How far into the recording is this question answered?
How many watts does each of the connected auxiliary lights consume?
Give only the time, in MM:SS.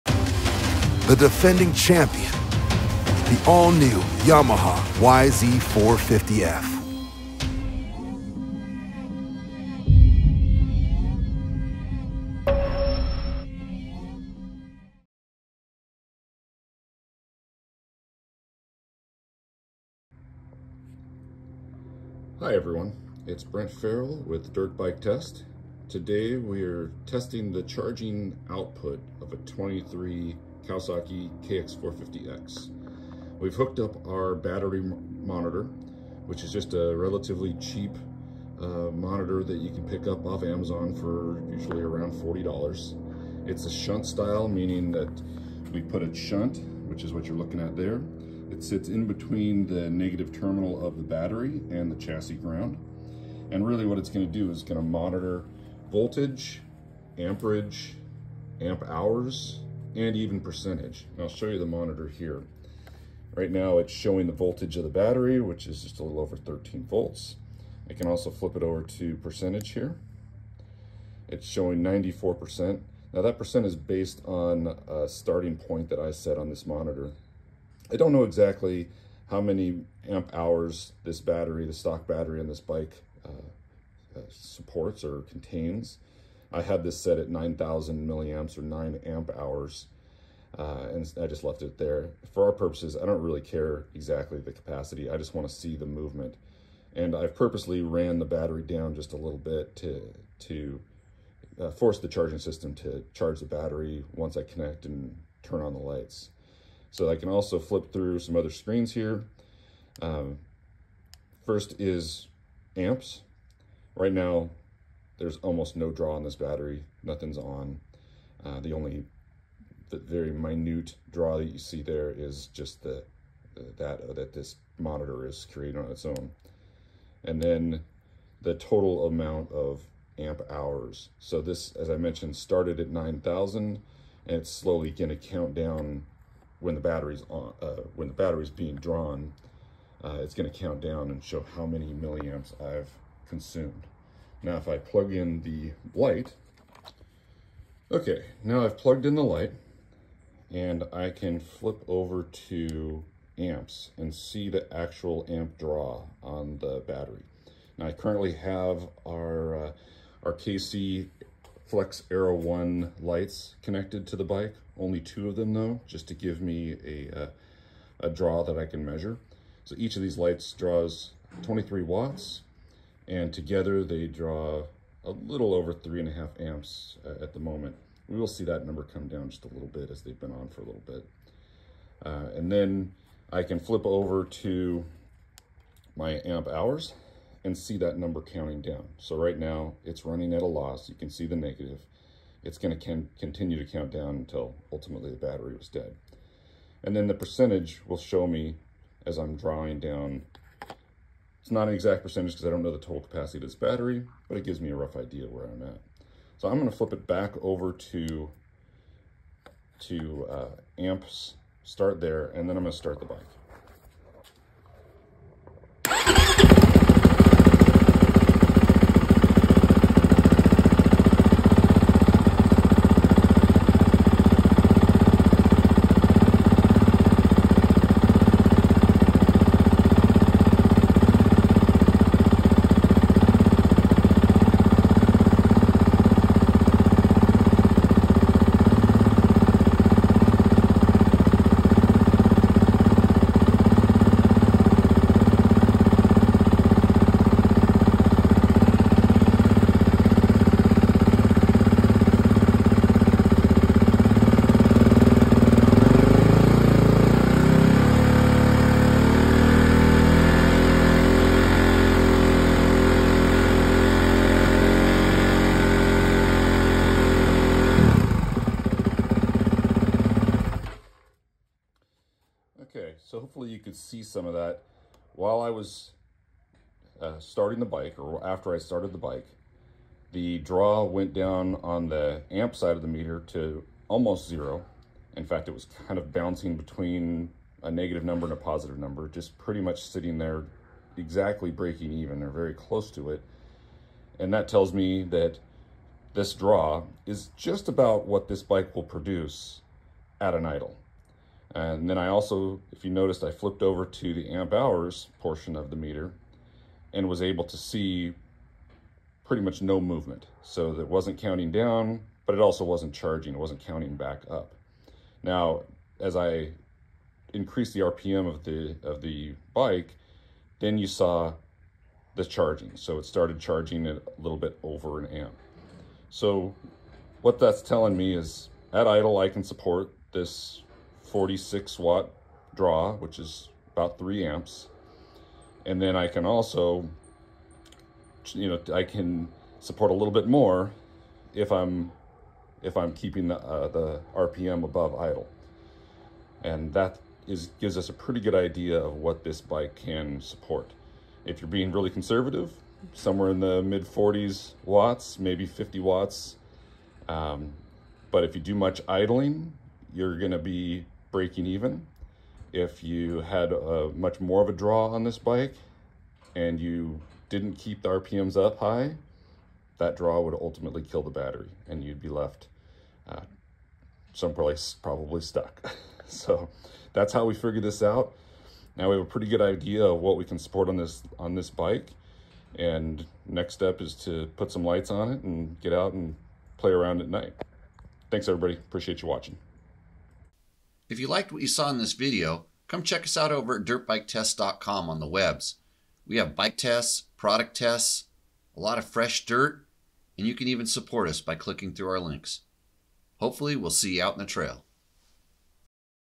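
02:51.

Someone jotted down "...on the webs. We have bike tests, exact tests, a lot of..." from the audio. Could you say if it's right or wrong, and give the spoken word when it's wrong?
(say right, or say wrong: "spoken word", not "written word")
wrong: "product", not "exact".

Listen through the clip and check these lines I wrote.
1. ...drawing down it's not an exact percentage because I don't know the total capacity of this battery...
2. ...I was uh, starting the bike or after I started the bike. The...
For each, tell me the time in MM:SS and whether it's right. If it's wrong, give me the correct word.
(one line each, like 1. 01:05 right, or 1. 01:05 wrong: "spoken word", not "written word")
1. 03:19 right
2. 04:35 right.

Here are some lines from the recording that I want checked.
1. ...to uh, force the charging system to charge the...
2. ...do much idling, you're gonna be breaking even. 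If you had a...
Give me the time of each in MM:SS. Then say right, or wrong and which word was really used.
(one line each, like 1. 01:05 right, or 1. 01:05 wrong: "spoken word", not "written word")
1. 01:40 right
2. 05:58 right.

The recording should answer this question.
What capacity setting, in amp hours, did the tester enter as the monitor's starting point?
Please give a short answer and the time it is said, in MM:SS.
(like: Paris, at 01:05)
9 amp hours, at 01:28.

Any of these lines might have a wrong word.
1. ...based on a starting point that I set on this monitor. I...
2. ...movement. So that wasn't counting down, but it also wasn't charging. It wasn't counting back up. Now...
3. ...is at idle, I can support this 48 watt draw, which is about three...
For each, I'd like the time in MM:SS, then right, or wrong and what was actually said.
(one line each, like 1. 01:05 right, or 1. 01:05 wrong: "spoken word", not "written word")
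1. 01:13 right
2. 05:09 right
3. 05:28 wrong: "46", not "48".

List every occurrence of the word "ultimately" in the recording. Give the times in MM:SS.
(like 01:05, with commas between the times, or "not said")
03:14, 06:10.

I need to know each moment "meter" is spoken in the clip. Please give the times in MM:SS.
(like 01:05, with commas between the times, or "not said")
04:42, 05:05.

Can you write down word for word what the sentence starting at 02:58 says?
We will see that number come down just a little bit as they've been on for a little bit.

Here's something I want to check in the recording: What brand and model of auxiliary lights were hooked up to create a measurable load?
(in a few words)
KC Flex Era 1.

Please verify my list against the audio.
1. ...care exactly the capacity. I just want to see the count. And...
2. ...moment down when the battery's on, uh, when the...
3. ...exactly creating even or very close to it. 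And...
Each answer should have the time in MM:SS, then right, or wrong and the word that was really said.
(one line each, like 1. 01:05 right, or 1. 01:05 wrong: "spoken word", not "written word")
1. 01:33 wrong: "movement", not "count"
2. 02:15 wrong: "count", not "moment"
3. 04:50 wrong: "breaking", not "creating".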